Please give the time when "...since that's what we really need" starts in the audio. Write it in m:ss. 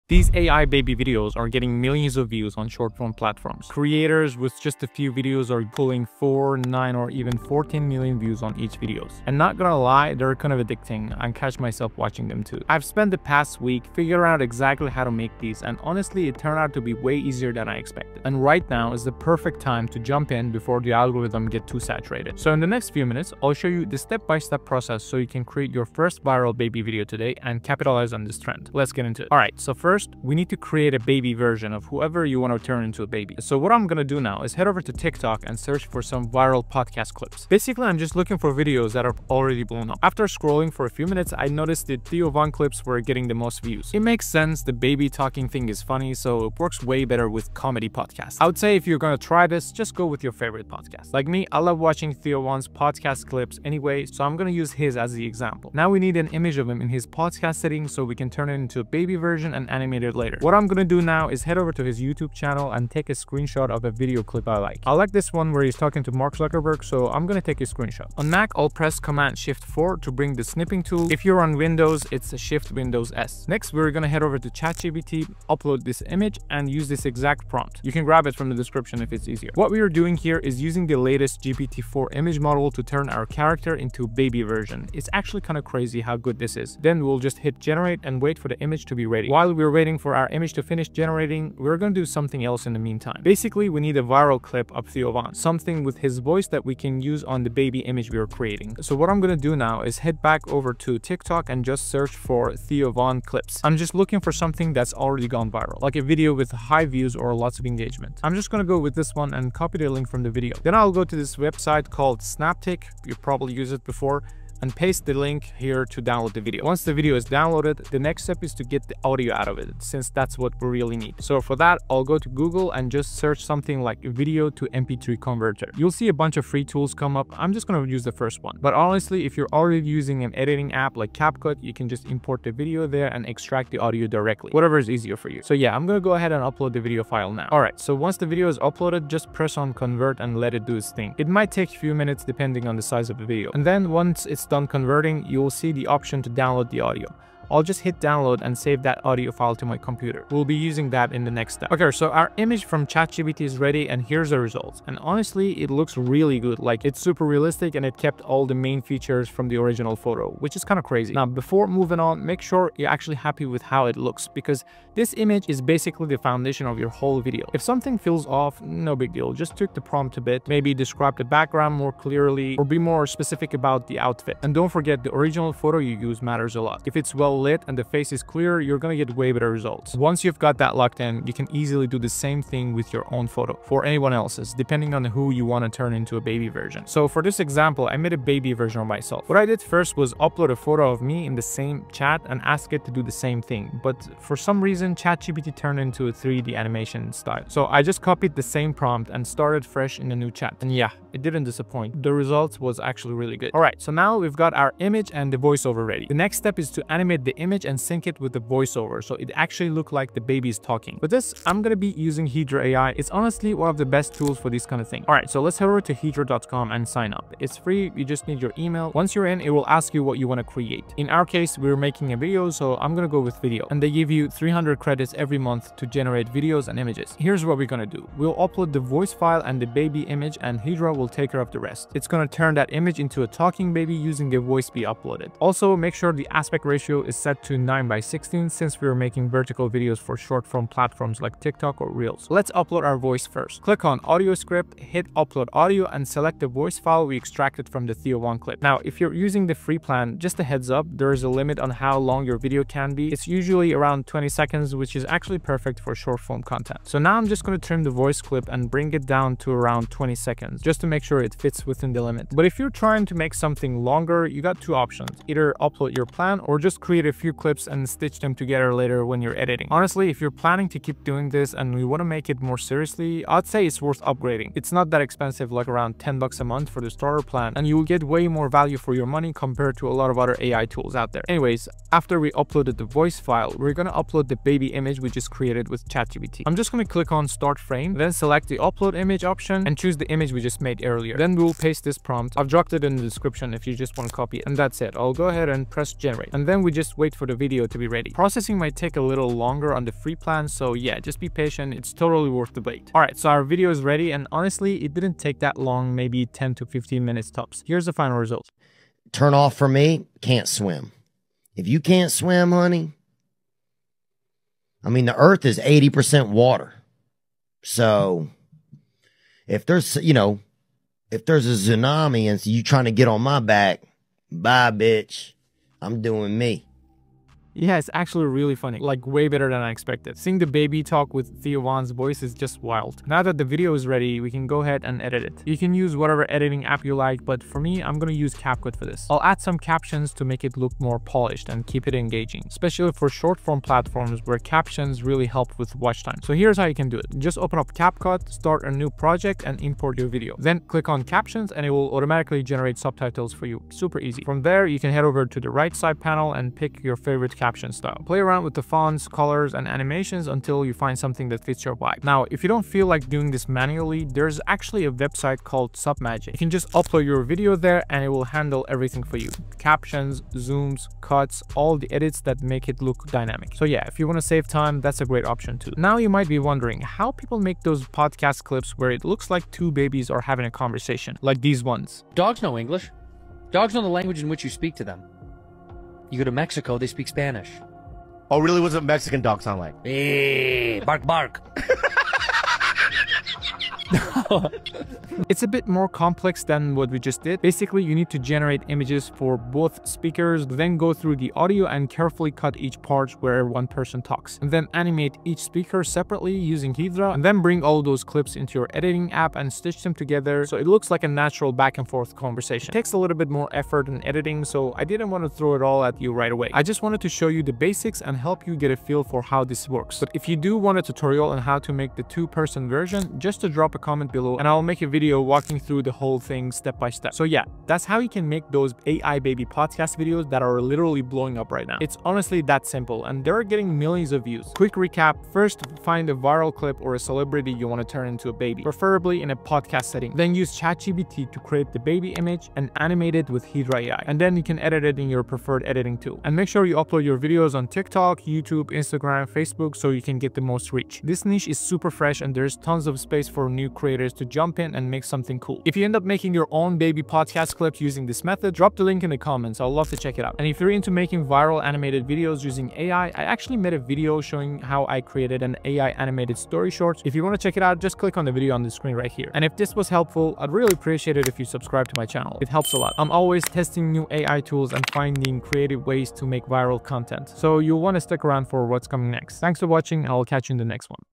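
1:59.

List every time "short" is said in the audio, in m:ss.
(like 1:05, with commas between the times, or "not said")
0:02, 4:00, 4:15, 5:43, 7:46.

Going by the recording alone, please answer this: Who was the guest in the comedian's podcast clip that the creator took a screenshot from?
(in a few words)
Mark Zuckerberg.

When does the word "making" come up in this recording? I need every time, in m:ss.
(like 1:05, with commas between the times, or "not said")
3:41, 3:59, 7:36, 7:40.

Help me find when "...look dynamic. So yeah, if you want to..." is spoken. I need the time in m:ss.
6:12.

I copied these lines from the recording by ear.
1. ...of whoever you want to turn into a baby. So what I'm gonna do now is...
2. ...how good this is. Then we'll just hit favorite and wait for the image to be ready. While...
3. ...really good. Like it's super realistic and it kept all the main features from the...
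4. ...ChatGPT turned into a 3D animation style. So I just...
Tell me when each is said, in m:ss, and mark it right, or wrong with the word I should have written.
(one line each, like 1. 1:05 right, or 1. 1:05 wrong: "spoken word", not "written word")
1. 0:31 right
2. 1:26 wrong: "generate", not "favorite"
3. 2:35 right
4. 3:14 right.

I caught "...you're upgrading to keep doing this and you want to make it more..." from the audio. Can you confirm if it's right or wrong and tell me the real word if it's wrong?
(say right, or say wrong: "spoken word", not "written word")
wrong: "planning", not "upgrading".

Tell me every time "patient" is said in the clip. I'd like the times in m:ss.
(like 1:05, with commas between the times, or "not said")
5:01.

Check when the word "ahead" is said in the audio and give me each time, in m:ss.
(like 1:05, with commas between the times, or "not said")
2:16, 4:55, 5:34.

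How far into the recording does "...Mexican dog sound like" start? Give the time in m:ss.
6:28.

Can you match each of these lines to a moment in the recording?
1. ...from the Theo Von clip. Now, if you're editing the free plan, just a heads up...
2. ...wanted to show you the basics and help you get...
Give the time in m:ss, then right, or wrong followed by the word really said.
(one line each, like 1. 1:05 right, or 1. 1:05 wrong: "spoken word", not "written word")
1. 4:07 wrong: "using", not "editing"
2. 6:56 right.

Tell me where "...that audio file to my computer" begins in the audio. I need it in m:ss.
2:28.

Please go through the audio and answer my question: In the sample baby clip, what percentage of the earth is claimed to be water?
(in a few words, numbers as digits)
80%.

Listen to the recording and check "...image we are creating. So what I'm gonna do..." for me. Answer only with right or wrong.
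right.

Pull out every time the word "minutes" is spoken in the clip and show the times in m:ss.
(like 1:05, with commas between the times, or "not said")
0:23, 0:41, 2:21, 5:07.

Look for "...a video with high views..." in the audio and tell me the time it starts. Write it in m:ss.
1:45.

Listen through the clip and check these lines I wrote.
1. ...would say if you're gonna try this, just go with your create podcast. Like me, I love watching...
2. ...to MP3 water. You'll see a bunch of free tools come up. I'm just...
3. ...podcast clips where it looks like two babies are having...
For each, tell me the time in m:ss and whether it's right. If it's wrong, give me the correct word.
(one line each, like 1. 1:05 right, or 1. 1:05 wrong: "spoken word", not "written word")
1. 0:48 wrong: "favorite", not "create"
2. 2:04 wrong: "converter", not "water"
3. 6:18 right.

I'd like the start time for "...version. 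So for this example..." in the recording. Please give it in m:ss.
3:06.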